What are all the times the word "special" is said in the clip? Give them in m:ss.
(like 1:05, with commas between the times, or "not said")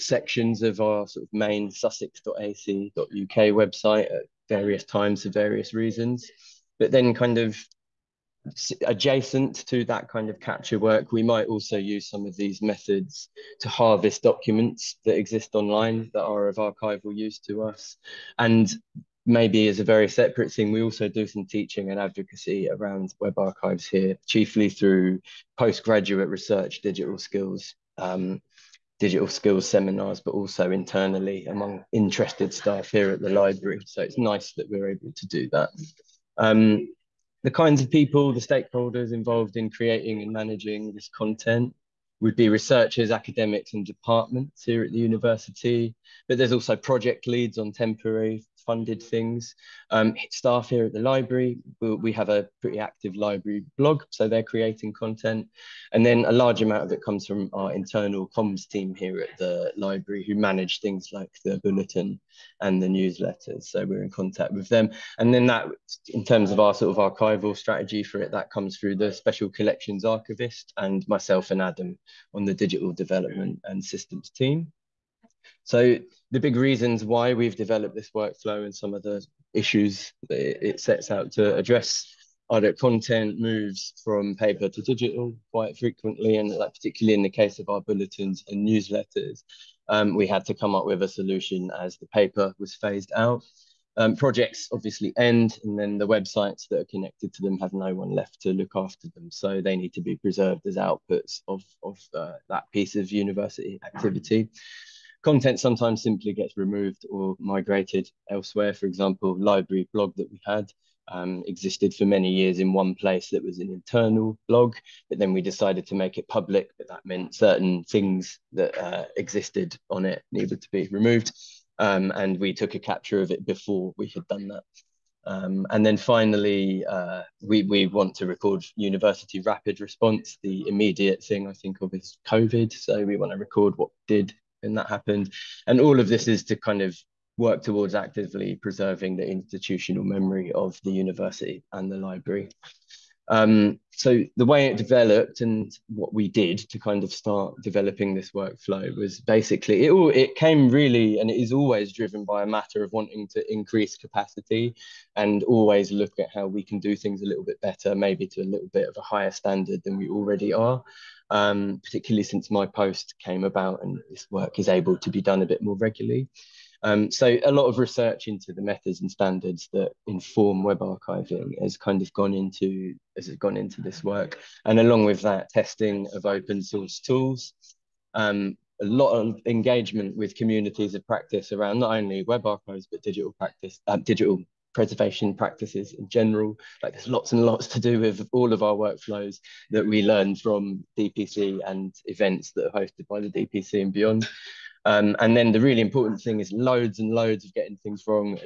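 1:09.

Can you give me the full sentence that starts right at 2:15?
And all of this is to kind of work towards actively preserving the institutional memory of the university and the library.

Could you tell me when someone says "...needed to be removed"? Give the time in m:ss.
2:00.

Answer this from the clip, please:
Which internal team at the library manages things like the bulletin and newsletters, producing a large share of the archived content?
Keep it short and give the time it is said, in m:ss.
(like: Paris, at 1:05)
internal comms team, at 0:57.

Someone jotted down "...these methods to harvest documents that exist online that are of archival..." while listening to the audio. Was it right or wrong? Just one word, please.
right.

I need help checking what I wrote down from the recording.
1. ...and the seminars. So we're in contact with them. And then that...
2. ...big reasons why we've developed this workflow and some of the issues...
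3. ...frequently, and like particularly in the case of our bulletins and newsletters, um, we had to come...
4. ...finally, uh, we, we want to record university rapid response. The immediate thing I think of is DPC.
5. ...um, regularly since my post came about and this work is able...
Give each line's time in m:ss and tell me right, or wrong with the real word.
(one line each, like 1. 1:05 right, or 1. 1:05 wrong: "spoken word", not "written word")
1. 1:02 wrong: "newsletters", not "seminars"
2. 1:16 right
3. 1:25 right
4. 2:05 wrong: "COVID", not "DPC"
5. 2:41 wrong: "particularly", not "regularly".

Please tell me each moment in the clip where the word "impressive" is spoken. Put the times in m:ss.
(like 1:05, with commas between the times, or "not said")
not said.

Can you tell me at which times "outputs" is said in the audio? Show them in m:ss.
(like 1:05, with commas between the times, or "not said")
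1:40.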